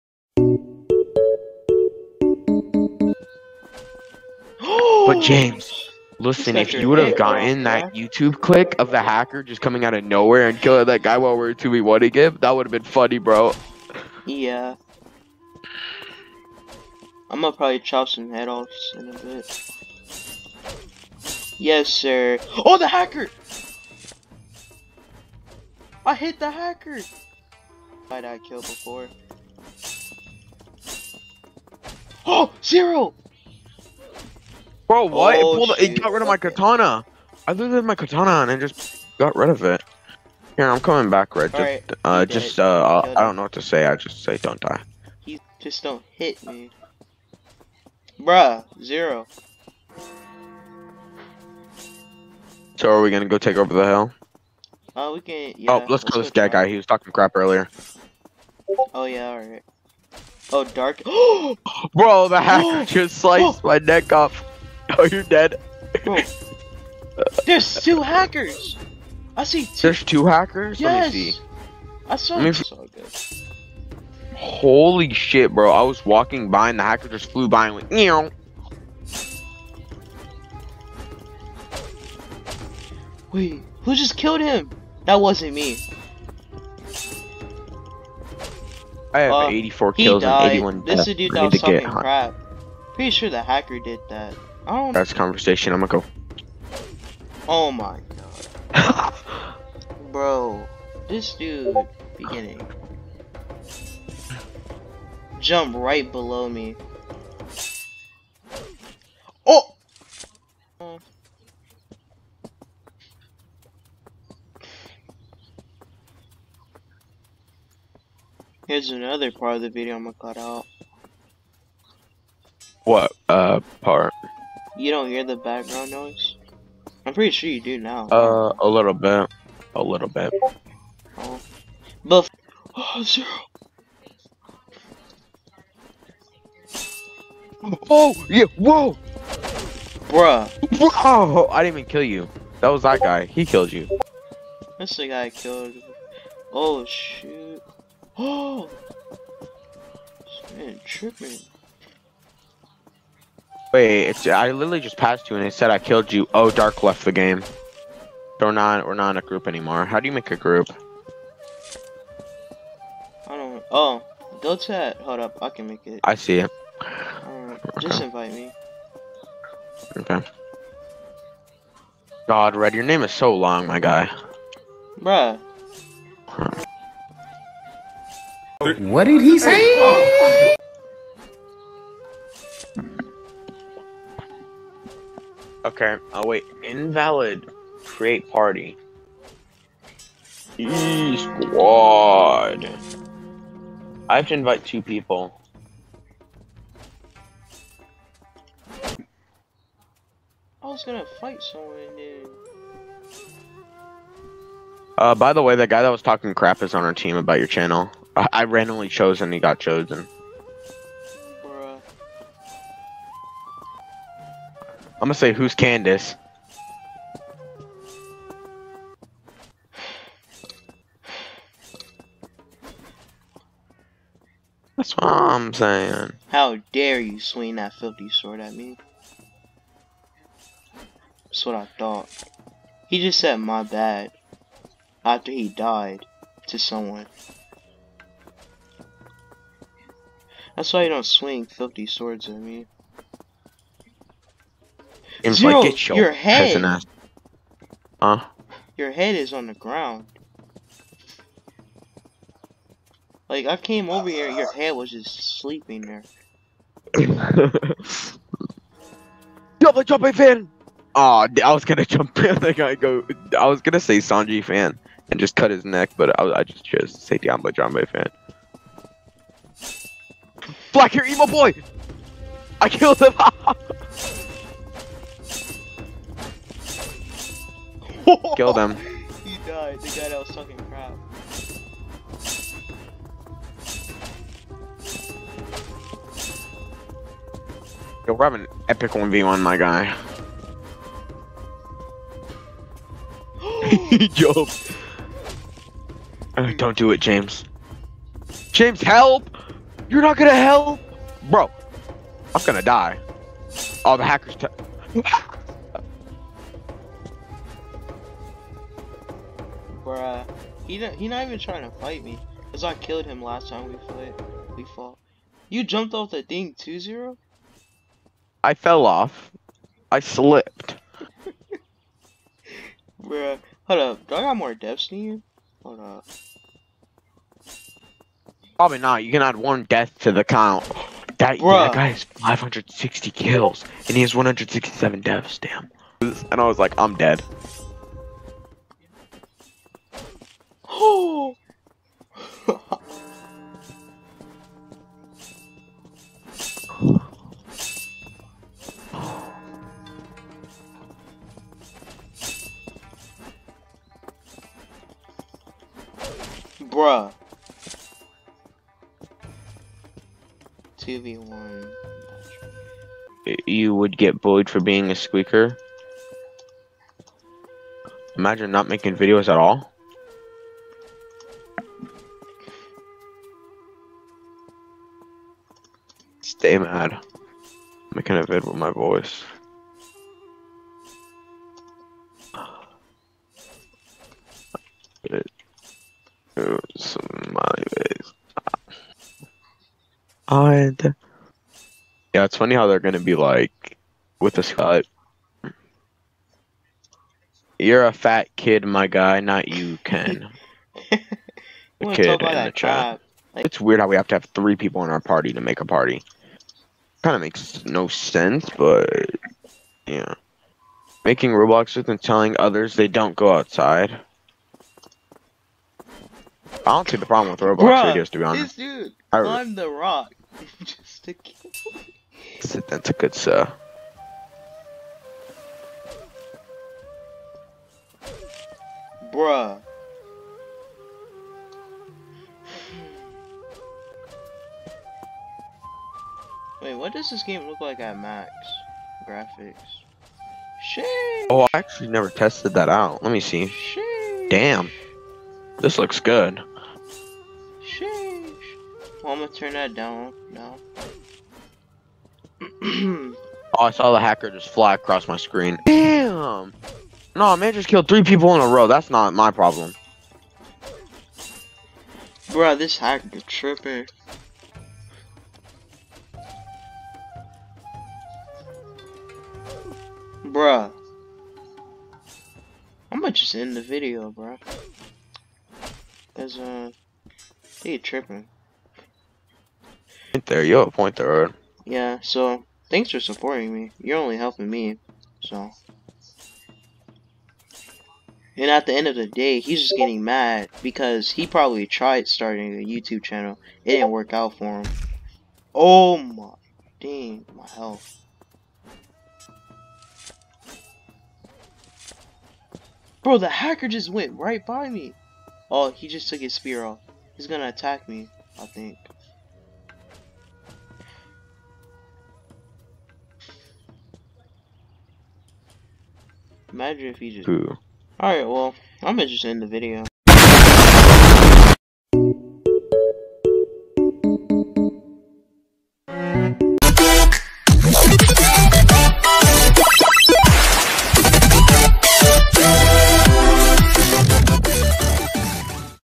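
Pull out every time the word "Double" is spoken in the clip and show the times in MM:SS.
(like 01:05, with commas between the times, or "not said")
04:19.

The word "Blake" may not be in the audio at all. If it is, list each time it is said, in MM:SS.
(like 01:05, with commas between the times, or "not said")
not said.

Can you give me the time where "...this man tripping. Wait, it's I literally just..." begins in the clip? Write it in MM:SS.
02:29.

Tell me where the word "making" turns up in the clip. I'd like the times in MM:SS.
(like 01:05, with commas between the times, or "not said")
06:08, 06:17, 06:51.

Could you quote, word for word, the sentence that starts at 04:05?
And Zero, like, get your, your head.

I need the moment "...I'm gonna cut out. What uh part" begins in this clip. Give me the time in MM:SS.
01:59.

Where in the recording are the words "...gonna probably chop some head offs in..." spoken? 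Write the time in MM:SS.
00:17.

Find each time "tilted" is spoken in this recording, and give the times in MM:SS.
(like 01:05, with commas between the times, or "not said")
not said.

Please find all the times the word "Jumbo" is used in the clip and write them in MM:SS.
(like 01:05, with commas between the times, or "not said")
04:27.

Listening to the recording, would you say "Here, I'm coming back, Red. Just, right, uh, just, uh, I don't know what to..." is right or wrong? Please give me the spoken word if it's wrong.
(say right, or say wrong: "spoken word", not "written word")
right.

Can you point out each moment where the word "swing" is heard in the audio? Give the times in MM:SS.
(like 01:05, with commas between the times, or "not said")
03:47, 04:01.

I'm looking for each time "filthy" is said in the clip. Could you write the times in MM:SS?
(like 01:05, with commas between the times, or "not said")
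03:47, 04:01.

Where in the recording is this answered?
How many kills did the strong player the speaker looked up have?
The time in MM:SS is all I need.
05:32.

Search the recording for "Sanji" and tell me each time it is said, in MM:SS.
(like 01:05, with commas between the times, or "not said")
04:23.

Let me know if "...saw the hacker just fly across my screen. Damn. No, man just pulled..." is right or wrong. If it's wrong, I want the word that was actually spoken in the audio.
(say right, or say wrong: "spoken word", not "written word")
wrong: "killed", not "pulled".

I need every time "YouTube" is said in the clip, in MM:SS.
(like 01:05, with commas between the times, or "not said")
00:07, 08:12.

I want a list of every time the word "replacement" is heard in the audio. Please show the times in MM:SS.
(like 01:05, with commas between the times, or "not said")
not said.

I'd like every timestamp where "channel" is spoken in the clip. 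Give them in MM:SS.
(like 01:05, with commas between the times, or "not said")
03:27, 08:13.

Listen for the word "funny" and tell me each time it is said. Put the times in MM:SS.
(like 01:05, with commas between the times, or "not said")
00:12, 06:32.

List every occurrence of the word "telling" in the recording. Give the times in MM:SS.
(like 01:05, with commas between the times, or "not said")
06:52.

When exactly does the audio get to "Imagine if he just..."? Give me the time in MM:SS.
08:36.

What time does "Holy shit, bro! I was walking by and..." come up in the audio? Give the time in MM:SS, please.
01:14.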